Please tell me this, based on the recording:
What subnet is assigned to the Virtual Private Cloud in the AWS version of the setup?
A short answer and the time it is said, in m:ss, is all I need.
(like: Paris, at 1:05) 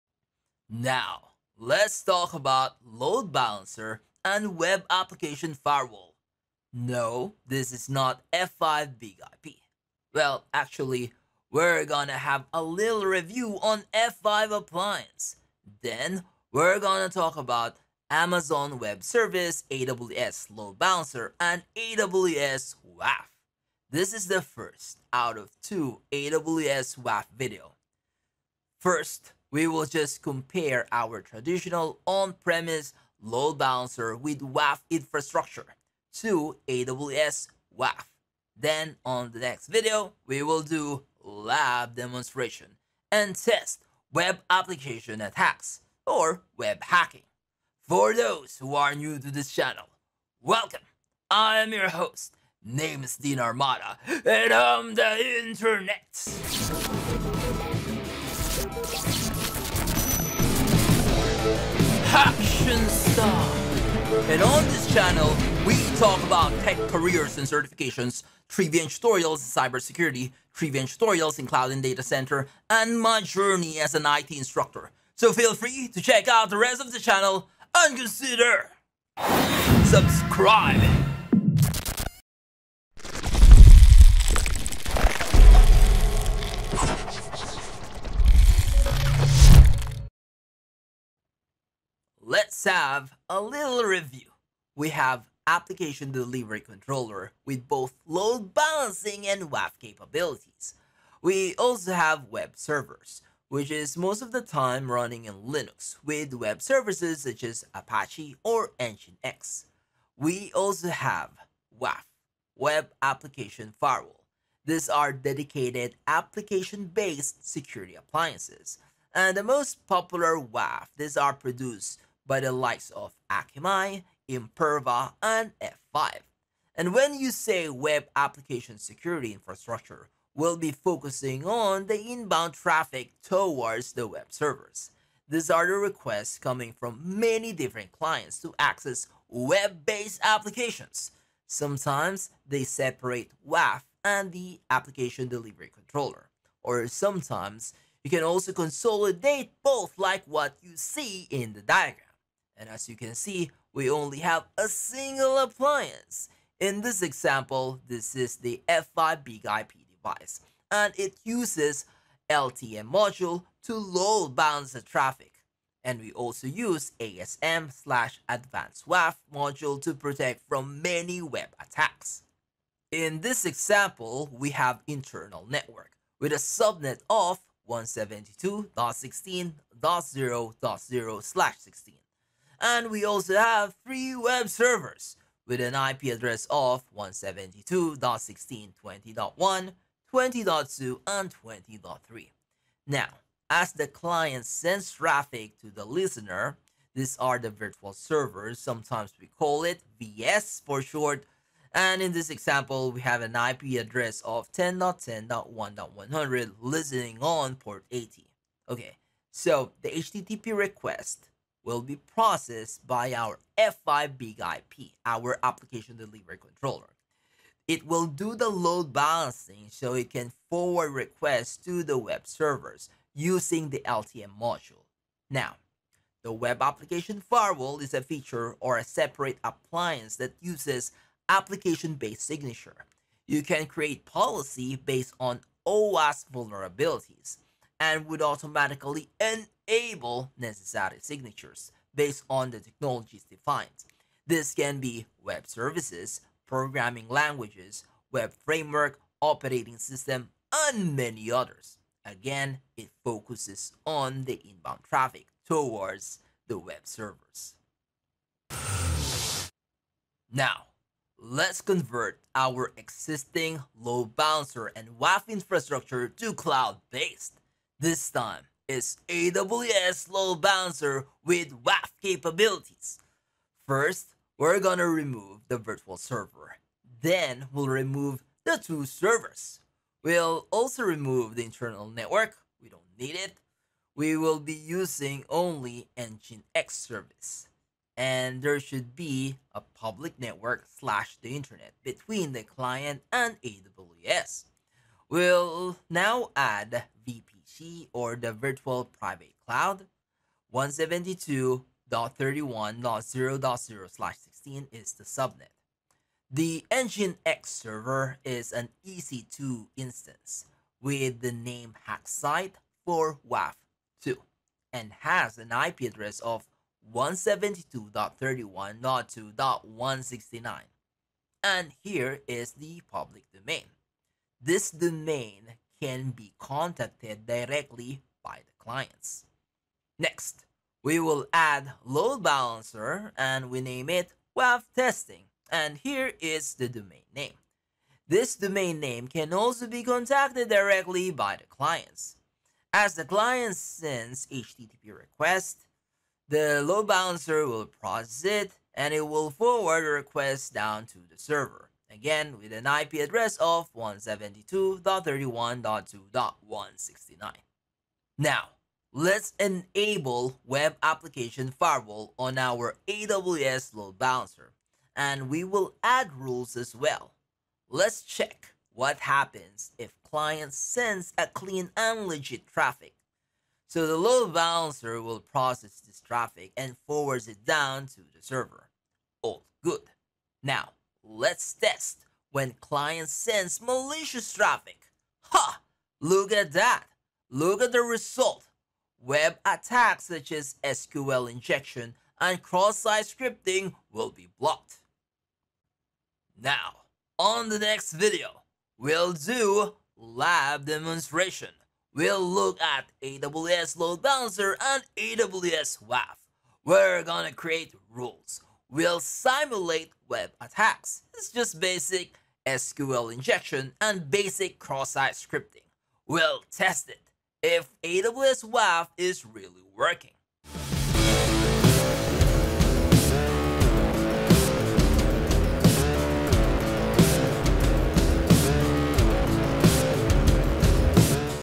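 172.31.0.0/16, at 5:00.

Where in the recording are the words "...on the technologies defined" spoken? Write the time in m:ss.
4:02.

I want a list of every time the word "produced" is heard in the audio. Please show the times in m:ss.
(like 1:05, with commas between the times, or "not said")
2:01.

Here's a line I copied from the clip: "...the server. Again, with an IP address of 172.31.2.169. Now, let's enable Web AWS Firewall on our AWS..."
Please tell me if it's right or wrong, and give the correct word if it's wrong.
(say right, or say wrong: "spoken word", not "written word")
wrong: "Application", not "AWS".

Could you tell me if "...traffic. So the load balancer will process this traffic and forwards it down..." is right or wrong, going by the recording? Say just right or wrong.
right.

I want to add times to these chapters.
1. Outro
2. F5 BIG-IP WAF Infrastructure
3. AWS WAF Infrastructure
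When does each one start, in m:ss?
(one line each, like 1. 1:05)
1. 6:35
2. 1:30
3. 4:19.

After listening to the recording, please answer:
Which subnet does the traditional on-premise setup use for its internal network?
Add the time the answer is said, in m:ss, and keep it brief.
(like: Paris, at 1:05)
172.16.0.0/16, at 2:57.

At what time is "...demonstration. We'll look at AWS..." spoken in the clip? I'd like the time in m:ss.
6:40.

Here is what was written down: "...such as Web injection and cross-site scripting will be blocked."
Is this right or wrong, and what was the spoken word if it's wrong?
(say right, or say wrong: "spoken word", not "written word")
wrong: "SQL", not "Web".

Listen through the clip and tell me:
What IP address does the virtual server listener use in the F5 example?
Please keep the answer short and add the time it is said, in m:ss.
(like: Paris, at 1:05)
10.10.1.100, at 3:24.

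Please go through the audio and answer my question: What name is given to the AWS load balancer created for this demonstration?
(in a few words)
WAF testing.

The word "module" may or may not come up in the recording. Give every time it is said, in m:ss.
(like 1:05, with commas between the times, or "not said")
2:42, 2:49, 3:44.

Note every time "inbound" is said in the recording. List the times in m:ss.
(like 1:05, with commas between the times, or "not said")
2:11, 4:14.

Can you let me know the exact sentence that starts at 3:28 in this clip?
Okay, so the HTTP request will be processed by our F5 Big IP, our application delivery controller.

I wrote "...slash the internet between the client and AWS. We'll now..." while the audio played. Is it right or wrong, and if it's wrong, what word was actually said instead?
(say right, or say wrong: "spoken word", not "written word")
right.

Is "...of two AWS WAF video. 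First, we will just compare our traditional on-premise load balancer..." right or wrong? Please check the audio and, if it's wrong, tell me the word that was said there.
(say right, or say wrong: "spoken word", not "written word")
right.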